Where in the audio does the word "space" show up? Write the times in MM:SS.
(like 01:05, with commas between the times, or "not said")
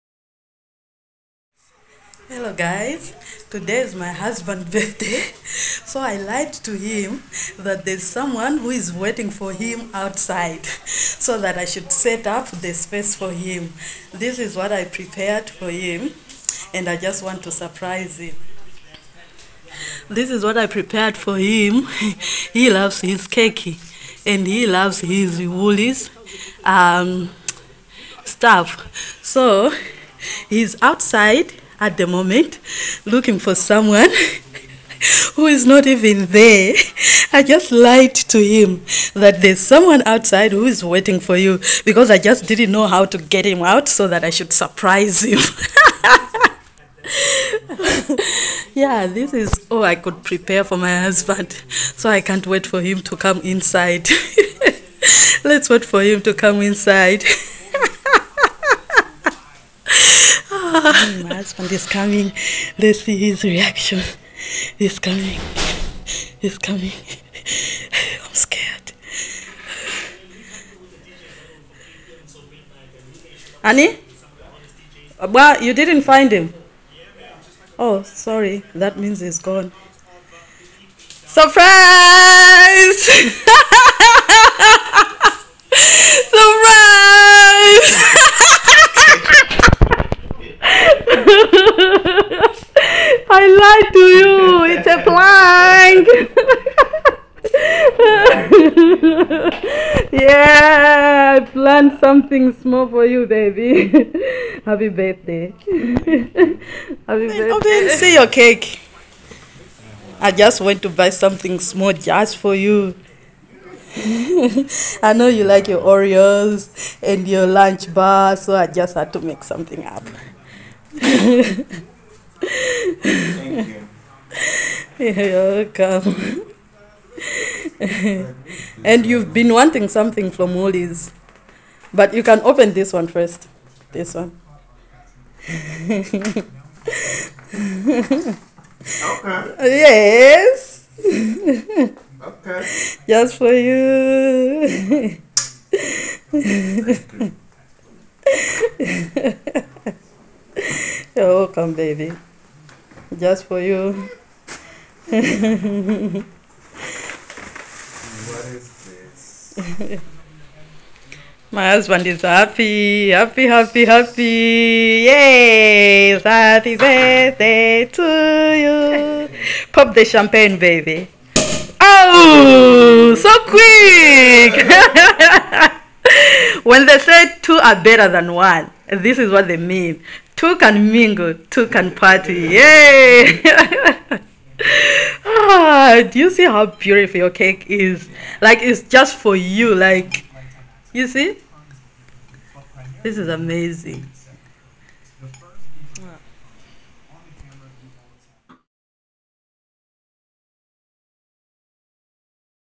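00:12.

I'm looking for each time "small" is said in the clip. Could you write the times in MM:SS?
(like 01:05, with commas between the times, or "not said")
01:42, 01:51.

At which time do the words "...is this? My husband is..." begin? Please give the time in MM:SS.
02:38.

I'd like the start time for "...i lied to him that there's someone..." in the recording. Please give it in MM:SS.
00:05.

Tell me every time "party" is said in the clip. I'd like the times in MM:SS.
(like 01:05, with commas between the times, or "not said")
03:01.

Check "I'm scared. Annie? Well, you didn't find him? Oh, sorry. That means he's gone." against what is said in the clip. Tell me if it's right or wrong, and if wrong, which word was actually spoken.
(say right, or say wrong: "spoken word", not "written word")
right.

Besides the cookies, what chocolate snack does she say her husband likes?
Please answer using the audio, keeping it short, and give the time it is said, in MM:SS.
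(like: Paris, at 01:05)
Lunch Bar, at 01:57.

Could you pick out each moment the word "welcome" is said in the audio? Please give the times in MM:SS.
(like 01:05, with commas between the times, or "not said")
02:05, 02:31.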